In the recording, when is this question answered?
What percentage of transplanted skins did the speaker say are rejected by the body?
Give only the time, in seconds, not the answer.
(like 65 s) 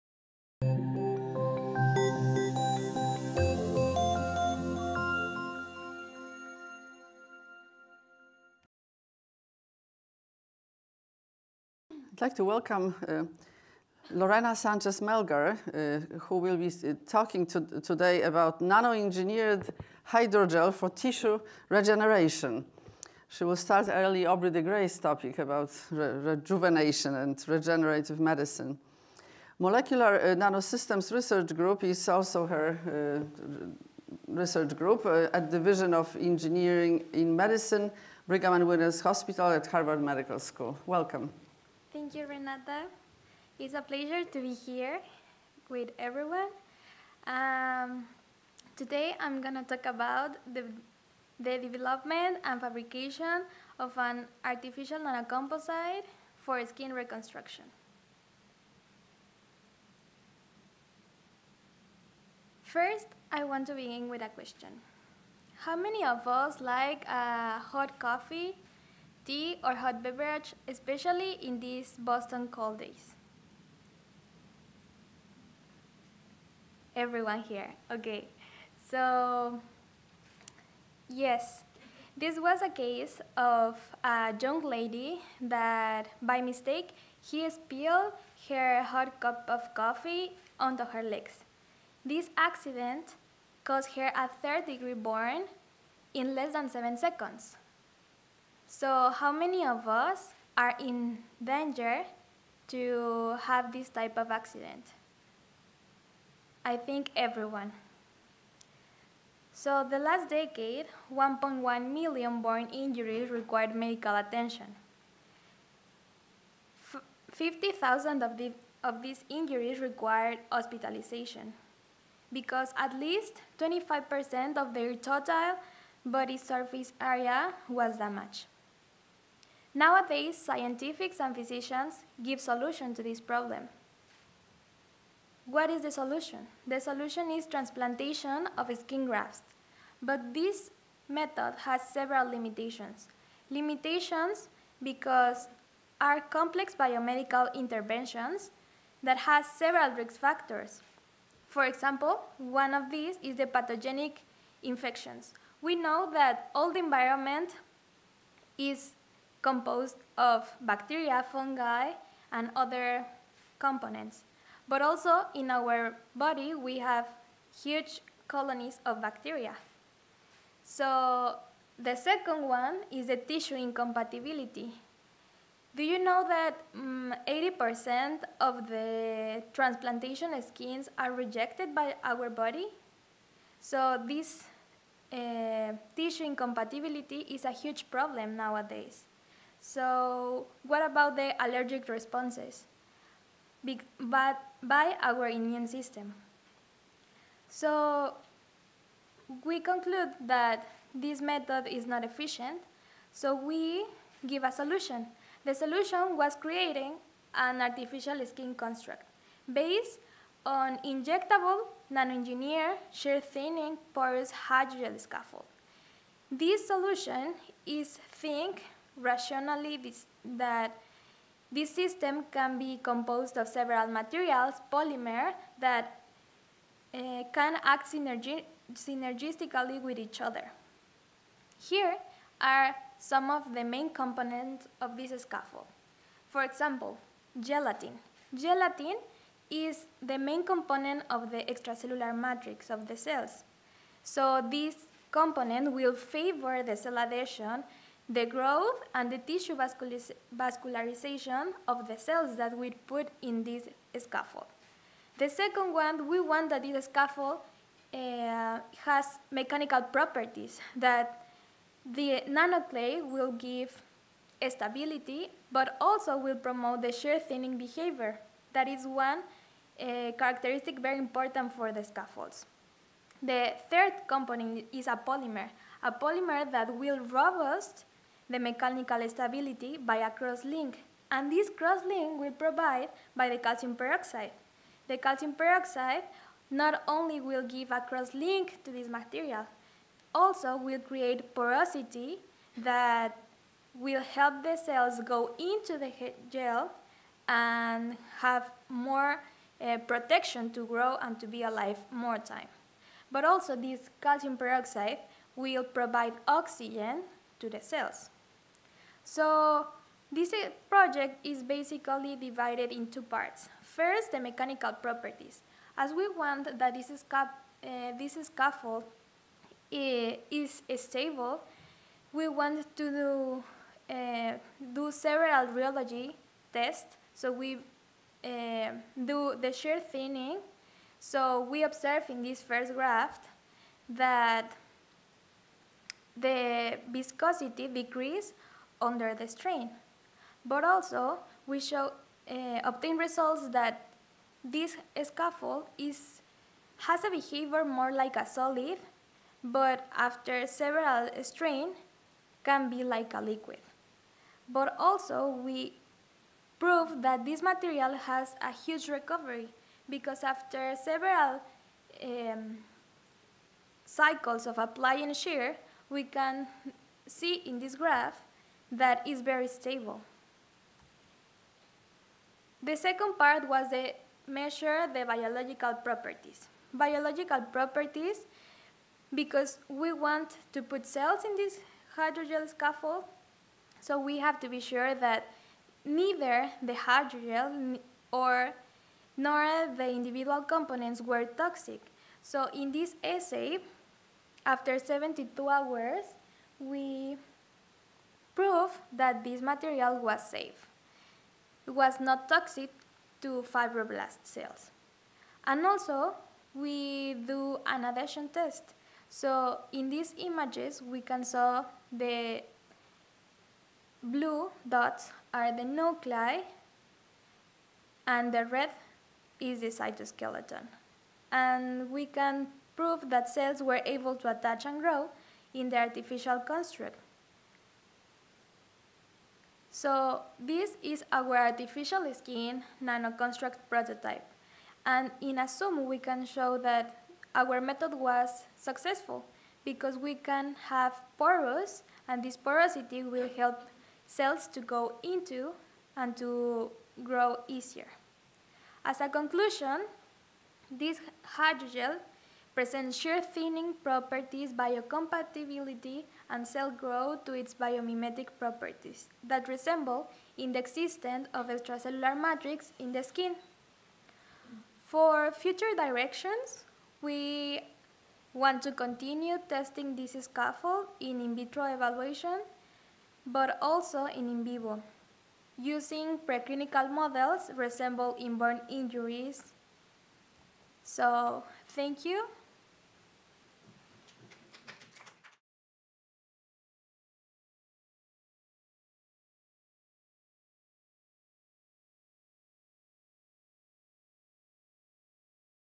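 176 s.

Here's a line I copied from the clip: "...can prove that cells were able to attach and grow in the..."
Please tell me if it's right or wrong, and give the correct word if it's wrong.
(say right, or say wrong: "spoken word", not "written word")
right.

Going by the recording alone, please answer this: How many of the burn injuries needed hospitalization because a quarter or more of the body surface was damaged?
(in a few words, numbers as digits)
50,000.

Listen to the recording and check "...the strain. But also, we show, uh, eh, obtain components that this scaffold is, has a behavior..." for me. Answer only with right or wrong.
wrong.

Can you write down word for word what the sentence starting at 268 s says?
That is one uh, characteristic very important for the scaffolds.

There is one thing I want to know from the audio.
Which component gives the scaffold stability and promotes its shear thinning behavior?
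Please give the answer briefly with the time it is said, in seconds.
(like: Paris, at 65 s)
nanoclay, at 262 s.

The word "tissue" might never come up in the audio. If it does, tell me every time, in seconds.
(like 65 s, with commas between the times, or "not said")
20 s, 173 s, 185 s, 249 s.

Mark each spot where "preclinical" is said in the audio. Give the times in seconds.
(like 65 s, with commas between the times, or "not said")
476 s.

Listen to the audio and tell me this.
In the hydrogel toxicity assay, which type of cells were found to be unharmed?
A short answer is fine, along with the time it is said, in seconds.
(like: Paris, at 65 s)
fibroblast cells, at 403 s.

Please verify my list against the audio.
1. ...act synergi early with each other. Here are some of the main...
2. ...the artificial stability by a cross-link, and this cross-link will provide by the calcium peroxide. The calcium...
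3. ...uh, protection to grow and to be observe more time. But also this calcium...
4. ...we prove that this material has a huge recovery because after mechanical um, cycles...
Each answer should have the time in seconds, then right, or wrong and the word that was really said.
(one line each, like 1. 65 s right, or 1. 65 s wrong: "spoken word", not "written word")
1. 227 s wrong: "synergistically", not "early"
2. 278 s wrong: "mechanical", not "artificial"
3. 299 s wrong: "alive", not "observe"
4. 355 s wrong: "several", not "mechanical".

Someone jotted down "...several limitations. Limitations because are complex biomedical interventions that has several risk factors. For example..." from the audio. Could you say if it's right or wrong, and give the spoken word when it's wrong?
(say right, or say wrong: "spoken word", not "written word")
right.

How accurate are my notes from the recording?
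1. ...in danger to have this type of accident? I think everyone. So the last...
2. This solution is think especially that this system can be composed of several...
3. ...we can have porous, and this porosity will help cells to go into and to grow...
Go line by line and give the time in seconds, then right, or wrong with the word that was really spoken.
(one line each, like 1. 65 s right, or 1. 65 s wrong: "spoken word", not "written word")
1. 100 s right
2. 216 s wrong: "rationally", not "especially"
3. 439 s right.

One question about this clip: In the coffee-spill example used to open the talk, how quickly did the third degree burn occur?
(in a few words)
less than 7 seconds.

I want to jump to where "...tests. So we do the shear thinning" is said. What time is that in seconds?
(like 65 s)
326 s.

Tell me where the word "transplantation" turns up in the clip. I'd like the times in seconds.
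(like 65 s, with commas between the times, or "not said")
137 s, 179 s.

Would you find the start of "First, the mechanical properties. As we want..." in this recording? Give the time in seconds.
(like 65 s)
313 s.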